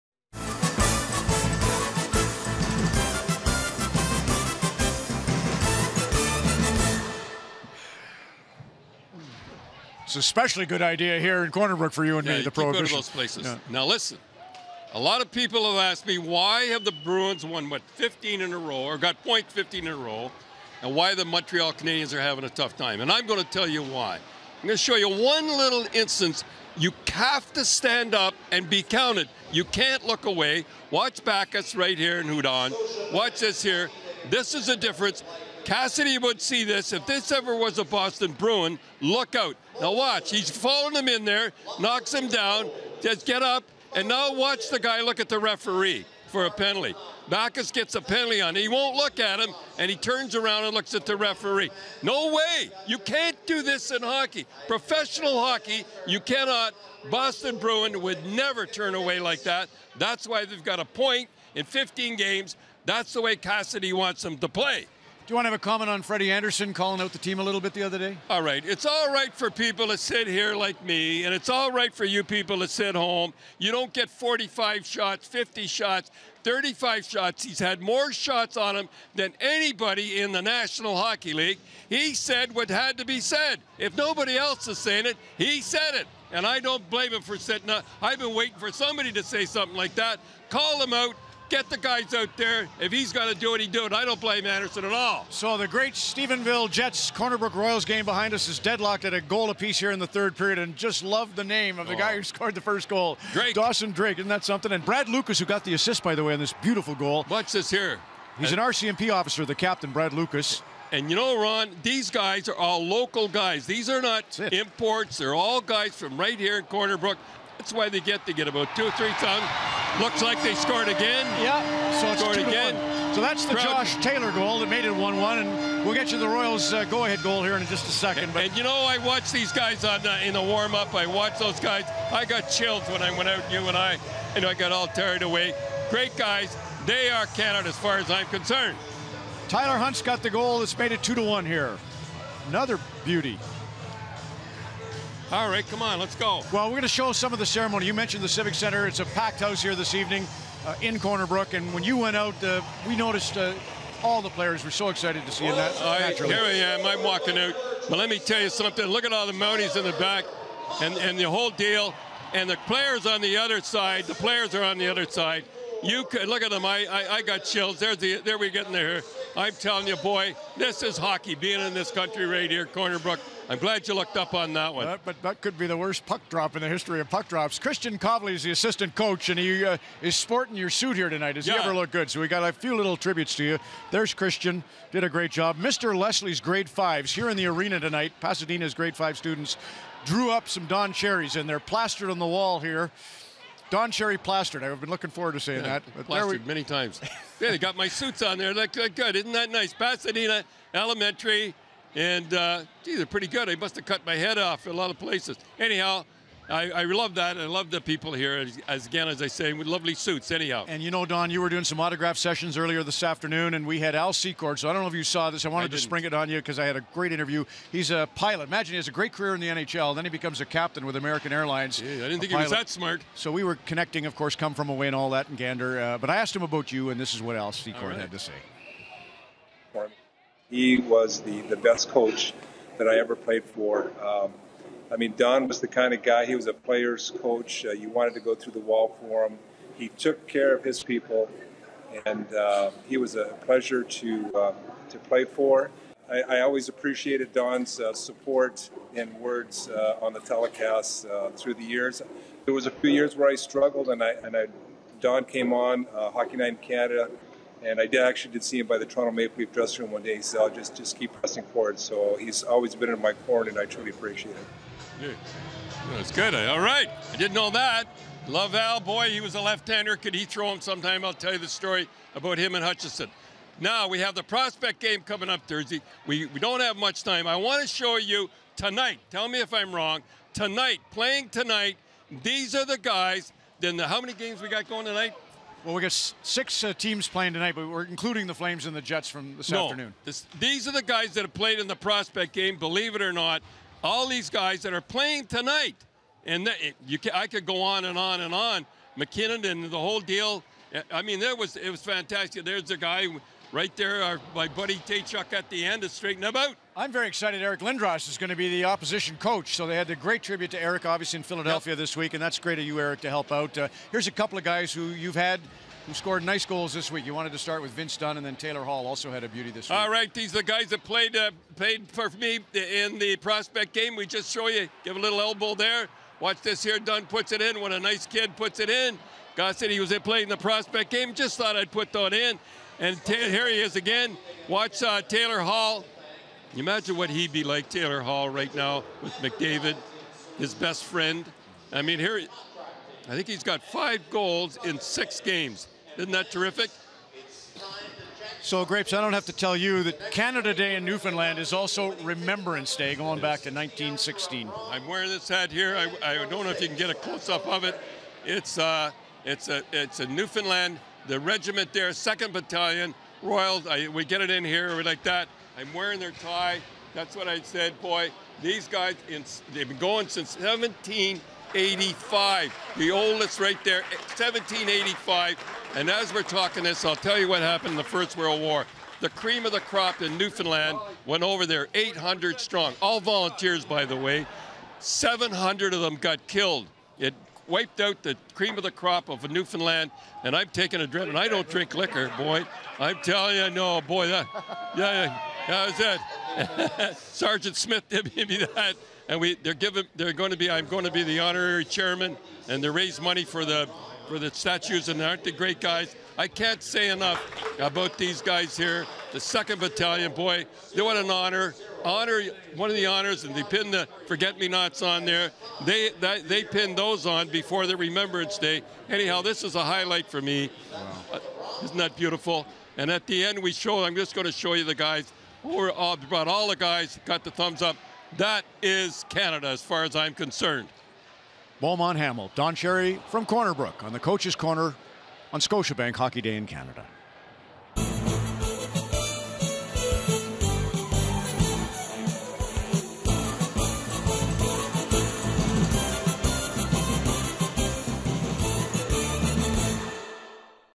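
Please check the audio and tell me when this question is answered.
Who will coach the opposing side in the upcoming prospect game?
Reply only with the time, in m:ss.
5:07.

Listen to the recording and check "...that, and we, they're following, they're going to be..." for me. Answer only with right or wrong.
wrong.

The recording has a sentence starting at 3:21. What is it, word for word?
And, uh, gee, they're pretty good.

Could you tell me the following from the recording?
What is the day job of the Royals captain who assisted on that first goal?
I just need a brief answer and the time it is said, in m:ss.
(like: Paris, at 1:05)
RCMP officer, at 1:48.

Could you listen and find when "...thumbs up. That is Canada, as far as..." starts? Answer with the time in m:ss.
7:07.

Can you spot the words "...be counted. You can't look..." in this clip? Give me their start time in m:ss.
0:28.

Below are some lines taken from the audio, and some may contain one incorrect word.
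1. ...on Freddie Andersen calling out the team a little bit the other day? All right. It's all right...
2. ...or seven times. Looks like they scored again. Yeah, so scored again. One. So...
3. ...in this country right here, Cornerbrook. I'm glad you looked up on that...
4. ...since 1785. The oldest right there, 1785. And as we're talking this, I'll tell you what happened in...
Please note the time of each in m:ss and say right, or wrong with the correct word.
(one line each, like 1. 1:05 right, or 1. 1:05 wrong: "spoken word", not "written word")
1. 1:05 right
2. 1:58 wrong: "three", not "seven"
3. 2:51 right
4. 6:10 right.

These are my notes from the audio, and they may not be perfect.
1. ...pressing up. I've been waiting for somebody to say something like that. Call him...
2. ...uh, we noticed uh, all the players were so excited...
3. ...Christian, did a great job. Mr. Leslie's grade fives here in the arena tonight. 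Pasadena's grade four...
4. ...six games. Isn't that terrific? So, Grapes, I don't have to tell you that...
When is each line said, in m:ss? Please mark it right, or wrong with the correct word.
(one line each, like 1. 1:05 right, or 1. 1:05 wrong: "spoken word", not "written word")
1. 1:27 wrong: "sitting", not "pressing"
2. 2:32 right
3. 3:04 wrong: "five", not "four"
4. 5:44 right.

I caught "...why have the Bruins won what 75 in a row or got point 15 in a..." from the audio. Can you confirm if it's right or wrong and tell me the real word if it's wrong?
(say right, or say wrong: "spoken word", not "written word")
wrong: "15", not "75".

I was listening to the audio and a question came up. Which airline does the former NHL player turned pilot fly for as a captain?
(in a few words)
American Airlines.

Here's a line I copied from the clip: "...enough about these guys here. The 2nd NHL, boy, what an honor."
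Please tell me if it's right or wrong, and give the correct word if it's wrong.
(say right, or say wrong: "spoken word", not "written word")
wrong: "Battalion", not "NHL".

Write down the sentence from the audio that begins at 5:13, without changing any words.
Uh, here's a couple of guys who you've had who scored nice goals this week.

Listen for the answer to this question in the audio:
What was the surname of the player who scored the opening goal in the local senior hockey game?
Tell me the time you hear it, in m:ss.
1:43.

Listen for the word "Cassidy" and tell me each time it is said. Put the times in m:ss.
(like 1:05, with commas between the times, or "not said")
0:35, 1:03.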